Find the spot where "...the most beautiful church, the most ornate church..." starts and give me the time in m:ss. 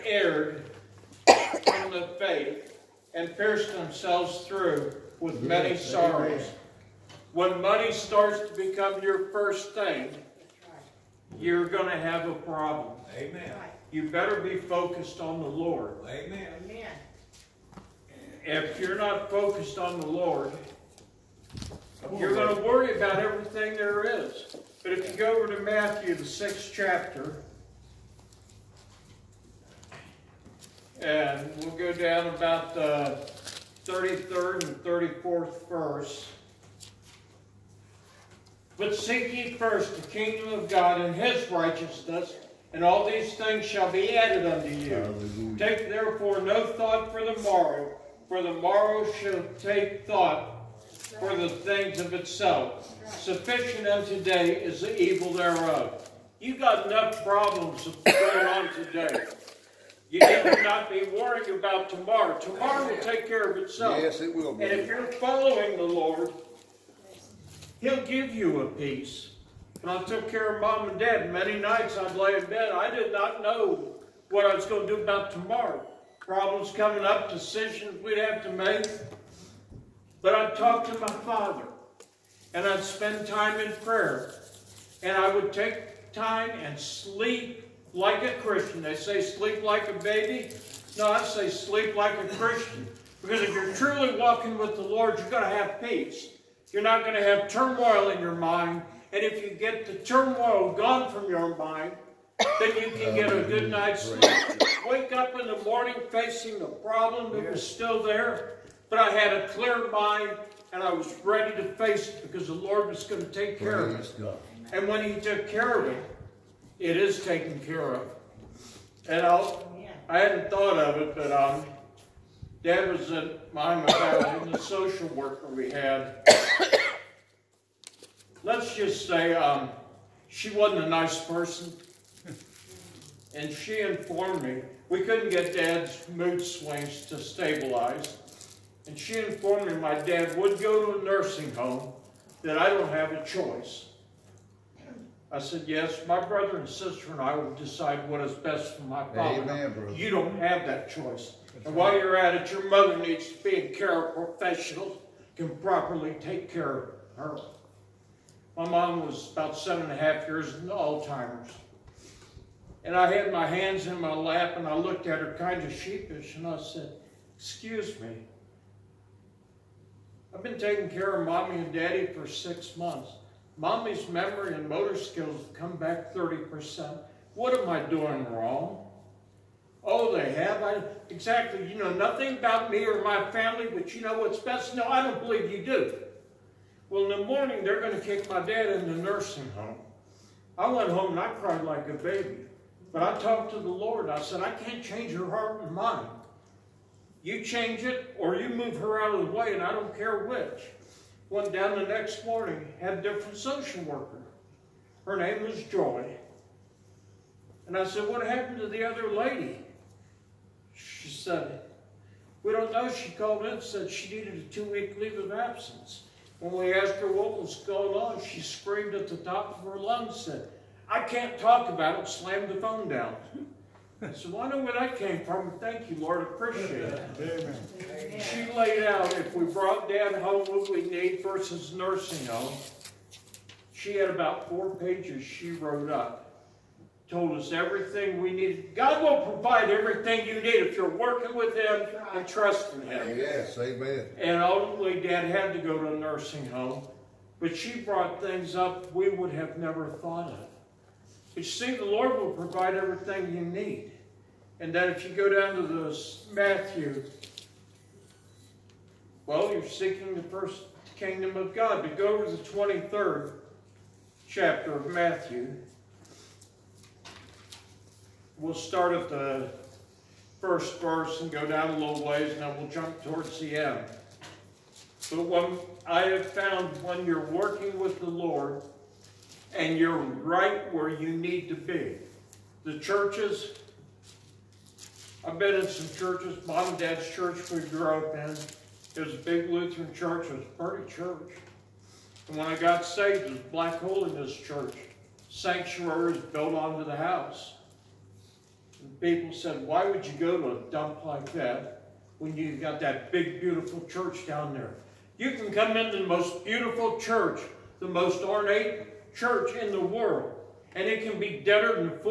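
5:05.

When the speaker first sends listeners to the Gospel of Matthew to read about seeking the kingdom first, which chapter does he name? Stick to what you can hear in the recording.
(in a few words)
6th chapter.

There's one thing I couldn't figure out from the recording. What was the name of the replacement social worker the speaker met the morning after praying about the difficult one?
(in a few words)
Joy.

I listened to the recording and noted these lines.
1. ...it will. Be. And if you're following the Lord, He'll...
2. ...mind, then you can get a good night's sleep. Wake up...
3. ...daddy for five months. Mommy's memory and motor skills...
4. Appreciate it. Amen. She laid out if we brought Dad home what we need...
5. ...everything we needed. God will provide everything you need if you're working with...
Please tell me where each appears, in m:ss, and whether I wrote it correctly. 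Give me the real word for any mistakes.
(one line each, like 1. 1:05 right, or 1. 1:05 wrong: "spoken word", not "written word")
1. 1:04 right
2. 1:41 right
3. 2:51 wrong: "six", not "five"
4. 3:46 right
5. 3:57 right.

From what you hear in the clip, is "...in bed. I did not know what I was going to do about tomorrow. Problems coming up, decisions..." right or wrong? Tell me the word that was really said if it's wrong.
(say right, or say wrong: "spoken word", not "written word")
right.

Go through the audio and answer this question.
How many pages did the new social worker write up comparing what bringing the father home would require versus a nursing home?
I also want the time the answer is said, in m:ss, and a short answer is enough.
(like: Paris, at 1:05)
4 pages, at 3:54.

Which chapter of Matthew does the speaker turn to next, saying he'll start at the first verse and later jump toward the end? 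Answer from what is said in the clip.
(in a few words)
23rd chapter.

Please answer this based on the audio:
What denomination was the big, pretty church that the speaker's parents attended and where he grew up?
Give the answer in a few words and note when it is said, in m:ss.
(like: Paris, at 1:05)
Lutheran, at 4:49.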